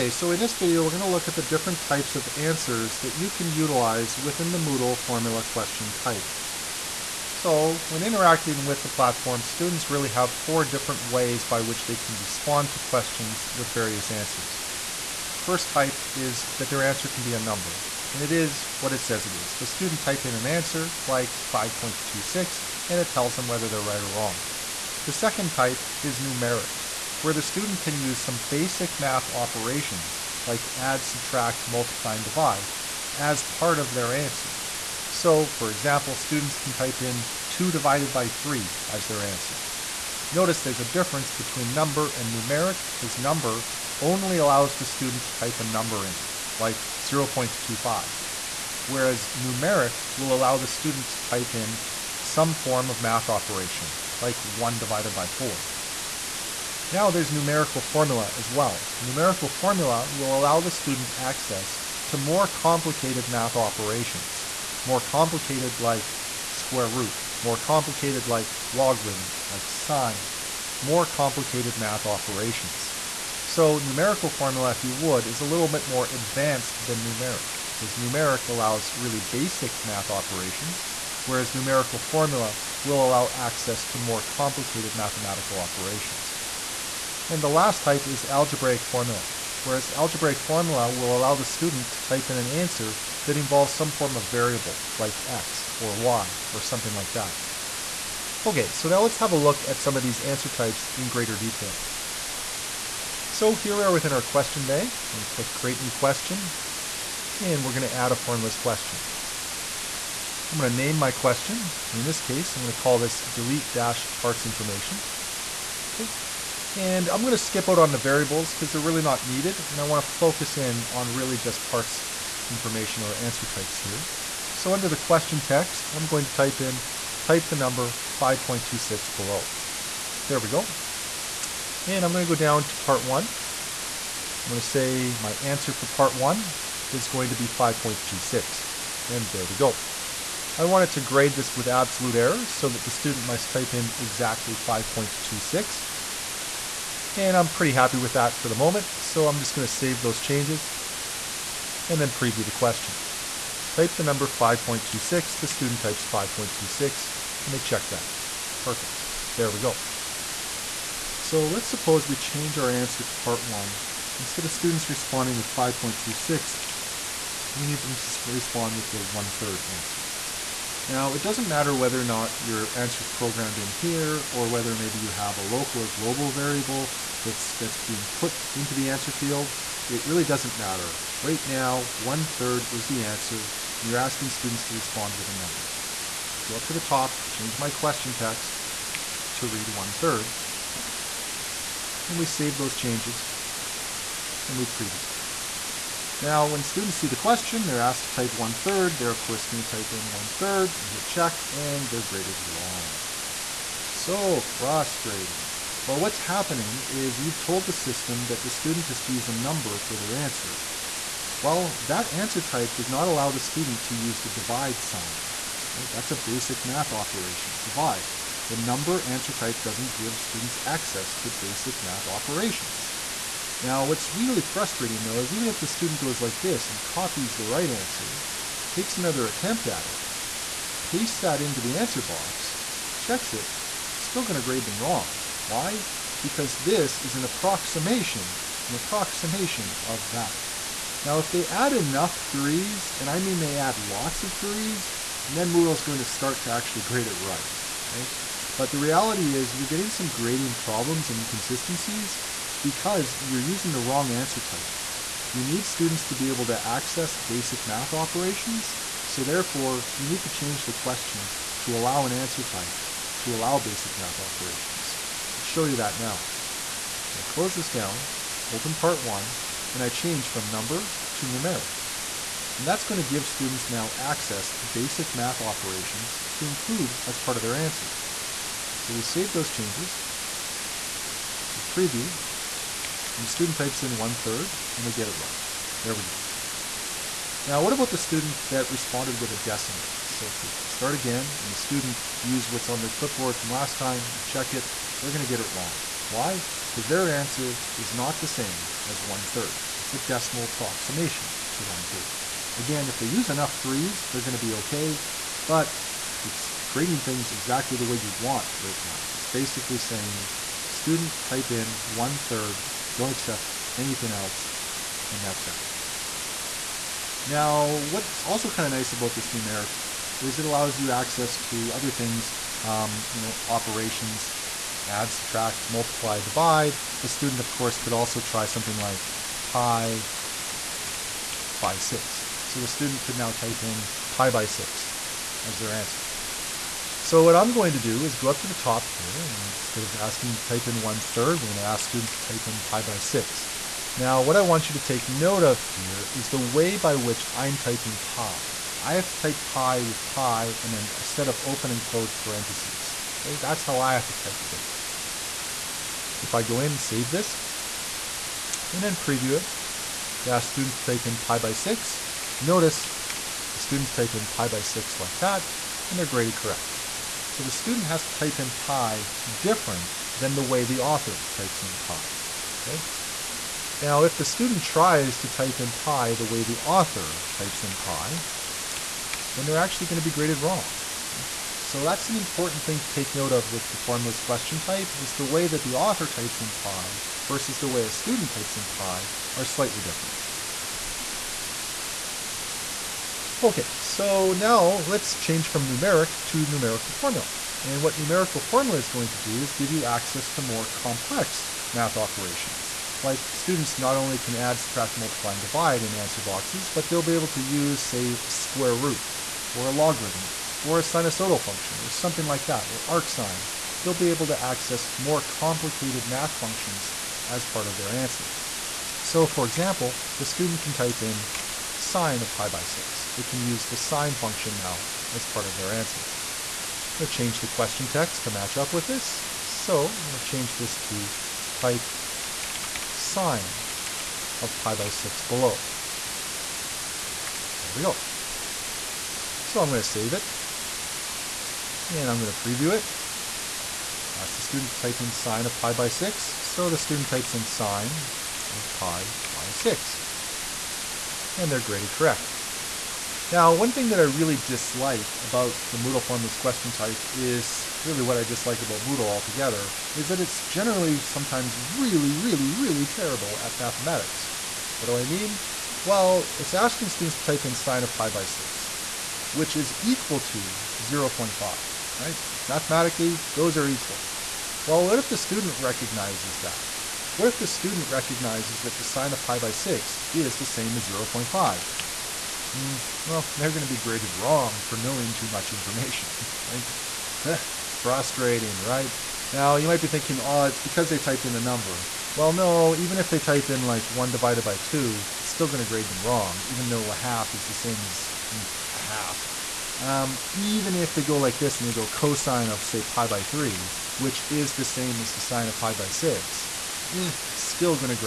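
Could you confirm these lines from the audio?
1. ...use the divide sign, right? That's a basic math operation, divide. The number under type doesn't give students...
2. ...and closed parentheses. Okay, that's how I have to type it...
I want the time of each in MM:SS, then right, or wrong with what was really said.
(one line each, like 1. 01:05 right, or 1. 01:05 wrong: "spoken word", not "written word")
1. 03:33 wrong: "answer", not "under"
2. 05:51 right.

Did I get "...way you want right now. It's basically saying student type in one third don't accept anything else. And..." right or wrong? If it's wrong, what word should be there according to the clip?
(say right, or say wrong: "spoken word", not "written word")
right.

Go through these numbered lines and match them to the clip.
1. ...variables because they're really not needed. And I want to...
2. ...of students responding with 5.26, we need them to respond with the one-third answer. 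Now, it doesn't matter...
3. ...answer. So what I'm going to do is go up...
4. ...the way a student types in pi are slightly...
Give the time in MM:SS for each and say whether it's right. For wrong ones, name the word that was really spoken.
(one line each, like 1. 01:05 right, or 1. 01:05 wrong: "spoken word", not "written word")
1. 01:57 right
2. 02:44 right
3. 05:35 right
4. 06:27 right.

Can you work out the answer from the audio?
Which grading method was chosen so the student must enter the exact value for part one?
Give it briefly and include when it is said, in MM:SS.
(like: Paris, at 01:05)
absolute error, at 02:21.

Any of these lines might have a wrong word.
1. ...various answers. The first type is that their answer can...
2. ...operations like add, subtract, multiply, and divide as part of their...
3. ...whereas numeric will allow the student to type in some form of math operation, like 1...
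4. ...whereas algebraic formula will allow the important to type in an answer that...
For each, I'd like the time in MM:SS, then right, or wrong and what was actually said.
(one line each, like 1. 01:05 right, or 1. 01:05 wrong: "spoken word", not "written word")
1. 00:13 right
2. 00:29 right
3. 00:48 right
4. 01:29 wrong: "student", not "important".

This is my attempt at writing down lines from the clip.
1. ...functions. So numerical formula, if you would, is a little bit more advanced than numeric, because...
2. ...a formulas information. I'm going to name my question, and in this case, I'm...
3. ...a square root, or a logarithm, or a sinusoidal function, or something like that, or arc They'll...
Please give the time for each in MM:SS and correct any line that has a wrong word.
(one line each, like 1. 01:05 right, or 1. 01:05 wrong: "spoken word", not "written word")
1. 01:12 wrong: "operations", not "functions"
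2. 01:48 wrong: "question", not "information"
3. 06:48 right.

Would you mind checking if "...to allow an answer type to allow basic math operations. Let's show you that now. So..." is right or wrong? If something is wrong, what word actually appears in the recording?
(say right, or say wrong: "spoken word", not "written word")
right.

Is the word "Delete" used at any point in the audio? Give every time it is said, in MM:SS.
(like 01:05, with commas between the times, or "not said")
01:53.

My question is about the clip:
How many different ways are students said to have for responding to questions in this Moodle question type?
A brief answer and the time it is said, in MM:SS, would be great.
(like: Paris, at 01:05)
4, at 00:10.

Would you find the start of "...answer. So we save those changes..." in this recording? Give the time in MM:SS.
04:37.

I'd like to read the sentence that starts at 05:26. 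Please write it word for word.
The student, of course, could also try something like pi by 6.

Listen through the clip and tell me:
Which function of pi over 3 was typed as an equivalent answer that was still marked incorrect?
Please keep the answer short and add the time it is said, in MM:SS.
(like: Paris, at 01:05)
cosine, at 08:21.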